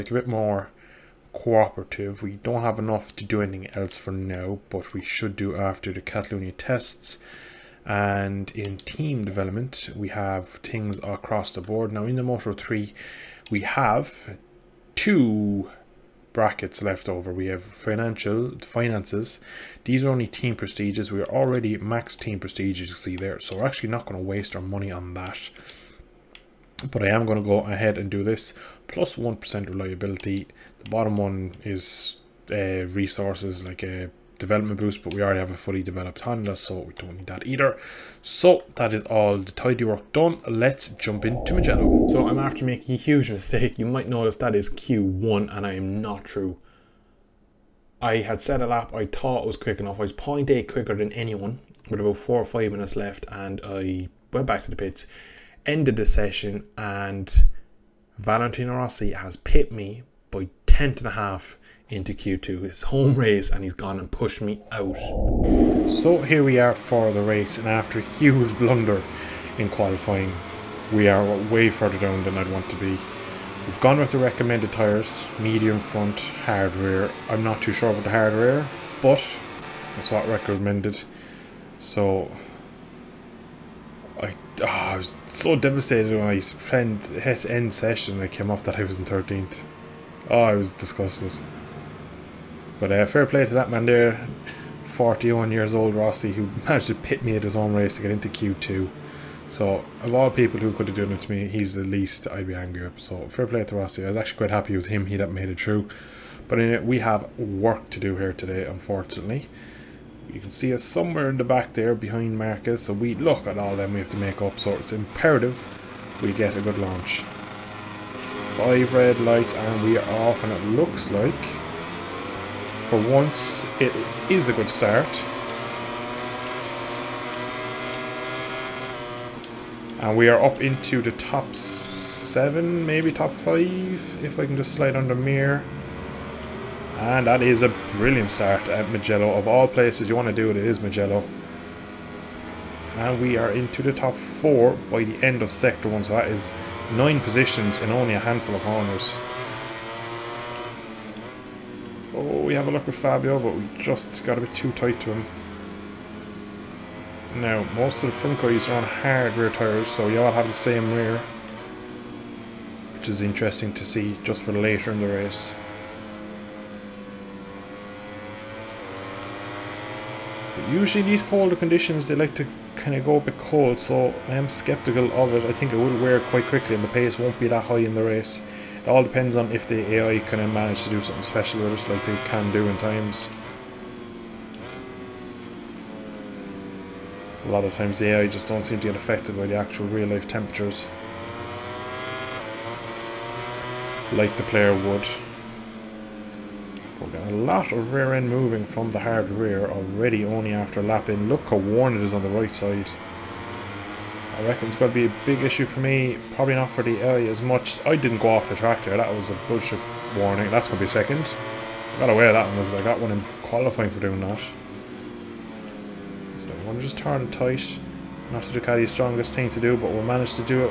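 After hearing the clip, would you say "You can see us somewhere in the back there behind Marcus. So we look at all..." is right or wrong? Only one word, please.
right.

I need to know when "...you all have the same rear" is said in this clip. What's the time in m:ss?
2:40.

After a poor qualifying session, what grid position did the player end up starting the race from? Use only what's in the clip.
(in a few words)
13th.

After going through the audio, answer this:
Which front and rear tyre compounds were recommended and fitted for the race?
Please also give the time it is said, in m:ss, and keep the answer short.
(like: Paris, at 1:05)
Medium front, hard rear, at 1:15.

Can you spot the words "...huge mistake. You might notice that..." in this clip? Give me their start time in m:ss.
0:42.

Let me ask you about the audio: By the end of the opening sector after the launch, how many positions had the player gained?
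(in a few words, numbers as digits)
9.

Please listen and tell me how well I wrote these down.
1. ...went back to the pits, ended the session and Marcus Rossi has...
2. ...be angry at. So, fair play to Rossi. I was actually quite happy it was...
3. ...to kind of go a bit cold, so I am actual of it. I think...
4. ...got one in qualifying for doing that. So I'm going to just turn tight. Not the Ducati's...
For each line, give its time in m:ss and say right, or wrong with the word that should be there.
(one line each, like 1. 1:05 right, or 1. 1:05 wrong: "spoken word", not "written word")
1. 0:54 wrong: "Valentino", not "Marcus"
2. 1:42 right
3. 2:52 wrong: "skeptical", not "actual"
4. 3:32 right.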